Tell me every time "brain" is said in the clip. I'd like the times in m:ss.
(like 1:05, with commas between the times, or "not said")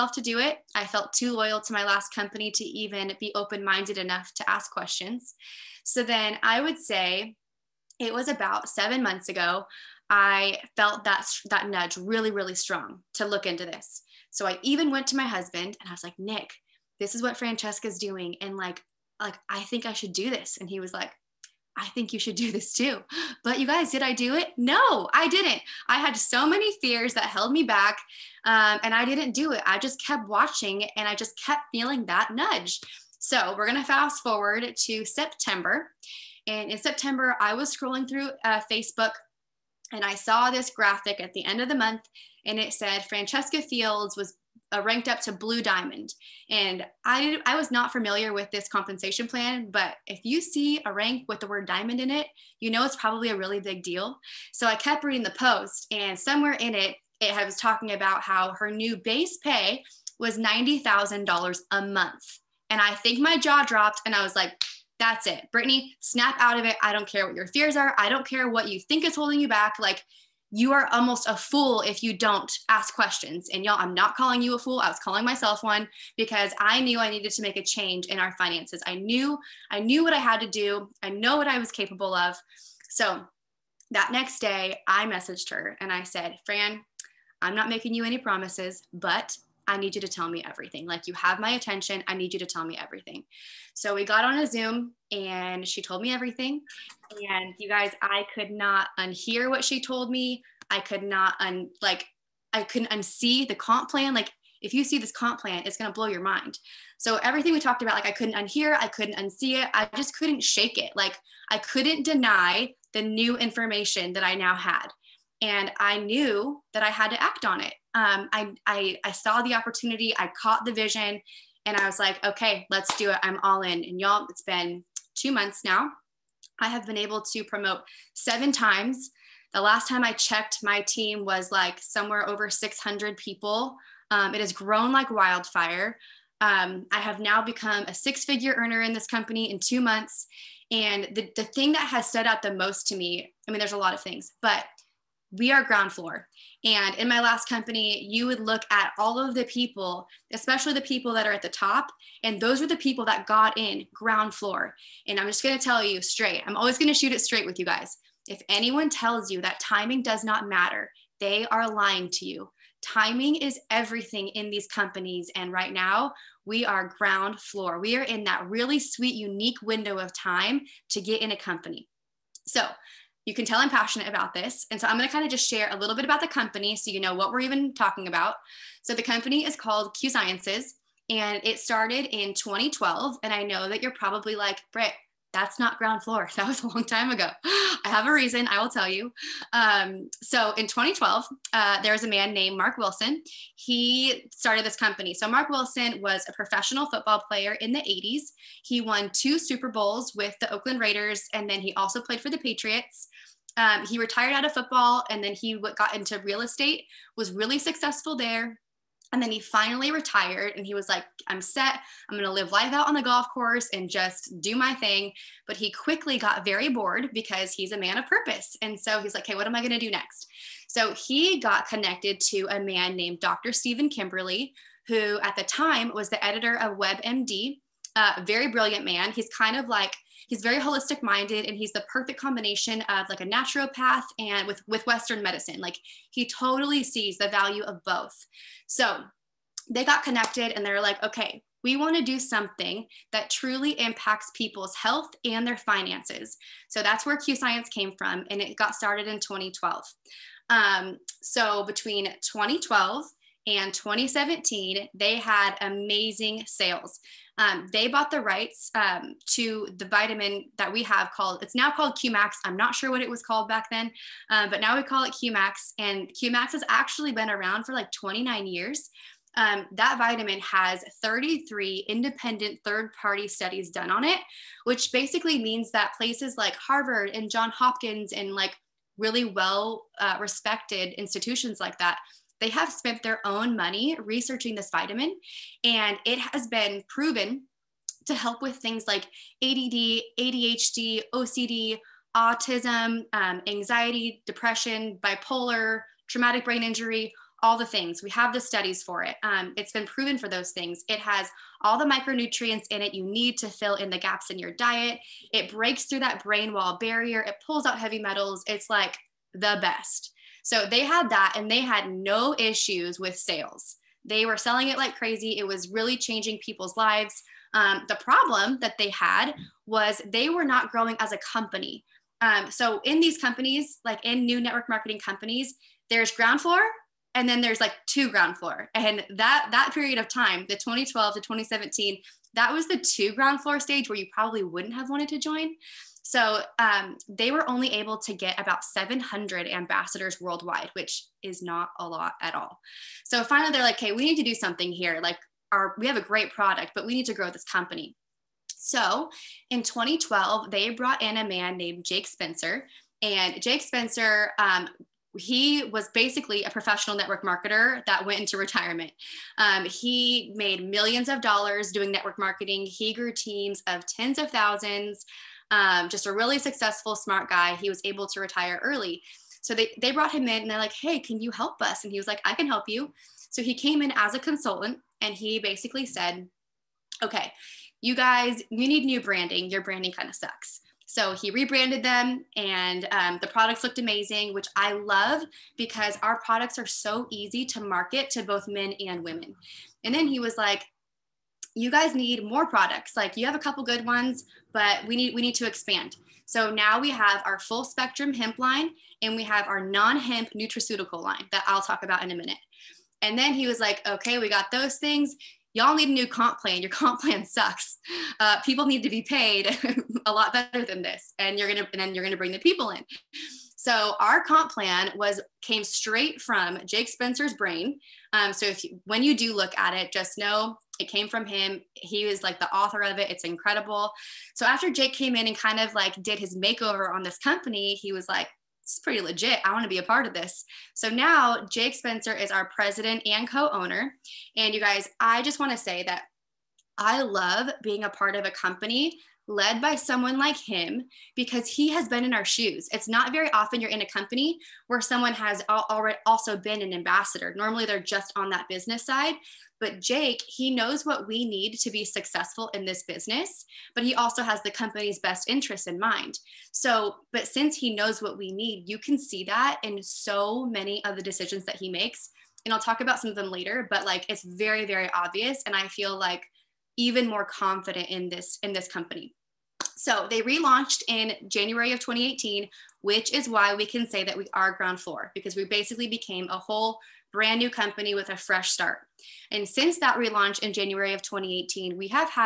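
4:56, 5:06, 6:57.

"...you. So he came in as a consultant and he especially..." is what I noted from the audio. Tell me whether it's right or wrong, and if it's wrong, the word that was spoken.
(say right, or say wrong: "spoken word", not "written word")
wrong: "basically", not "especially".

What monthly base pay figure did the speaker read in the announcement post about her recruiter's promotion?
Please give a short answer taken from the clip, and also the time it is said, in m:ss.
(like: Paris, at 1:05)
$90,000, at 1:00.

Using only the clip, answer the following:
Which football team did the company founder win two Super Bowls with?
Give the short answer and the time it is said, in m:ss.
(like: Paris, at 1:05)
Oakland Raiders, at 3:20.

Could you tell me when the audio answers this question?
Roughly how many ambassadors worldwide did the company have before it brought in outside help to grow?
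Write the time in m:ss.
5:38.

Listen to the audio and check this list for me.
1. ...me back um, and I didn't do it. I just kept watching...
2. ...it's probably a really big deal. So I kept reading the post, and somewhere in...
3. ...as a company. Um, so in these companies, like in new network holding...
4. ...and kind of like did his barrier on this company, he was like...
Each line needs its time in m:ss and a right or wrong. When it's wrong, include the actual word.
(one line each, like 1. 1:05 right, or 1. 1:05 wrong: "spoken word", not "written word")
1. 0:27 right
2. 0:52 right
3. 5:20 wrong: "marketing", not "holding"
4. 7:05 wrong: "makeover", not "barrier".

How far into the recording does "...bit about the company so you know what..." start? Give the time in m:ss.
2:55.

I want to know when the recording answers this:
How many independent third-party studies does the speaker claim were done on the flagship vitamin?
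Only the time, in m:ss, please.
4:31.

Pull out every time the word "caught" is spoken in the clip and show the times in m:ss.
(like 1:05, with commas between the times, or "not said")
2:00.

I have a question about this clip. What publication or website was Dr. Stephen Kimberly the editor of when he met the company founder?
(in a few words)
WebMD.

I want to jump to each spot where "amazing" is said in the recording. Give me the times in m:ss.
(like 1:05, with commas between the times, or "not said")
4:15, 6:23.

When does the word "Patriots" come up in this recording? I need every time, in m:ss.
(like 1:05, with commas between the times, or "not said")
3:22.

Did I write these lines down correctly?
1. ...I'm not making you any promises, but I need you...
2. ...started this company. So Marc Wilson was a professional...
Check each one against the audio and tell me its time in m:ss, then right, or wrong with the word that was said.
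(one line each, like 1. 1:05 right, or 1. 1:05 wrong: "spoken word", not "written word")
1. 1:27 right
2. 3:14 right.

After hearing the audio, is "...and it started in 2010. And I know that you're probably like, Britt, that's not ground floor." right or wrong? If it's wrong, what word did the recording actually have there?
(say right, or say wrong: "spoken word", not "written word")
wrong: "2012", not "2010".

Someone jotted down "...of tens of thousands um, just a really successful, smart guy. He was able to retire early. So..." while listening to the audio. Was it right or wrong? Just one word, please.
right.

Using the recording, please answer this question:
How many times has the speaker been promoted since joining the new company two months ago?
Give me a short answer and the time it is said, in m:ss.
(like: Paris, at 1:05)
7, at 2:08.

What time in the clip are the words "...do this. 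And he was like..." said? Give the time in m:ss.
0:20.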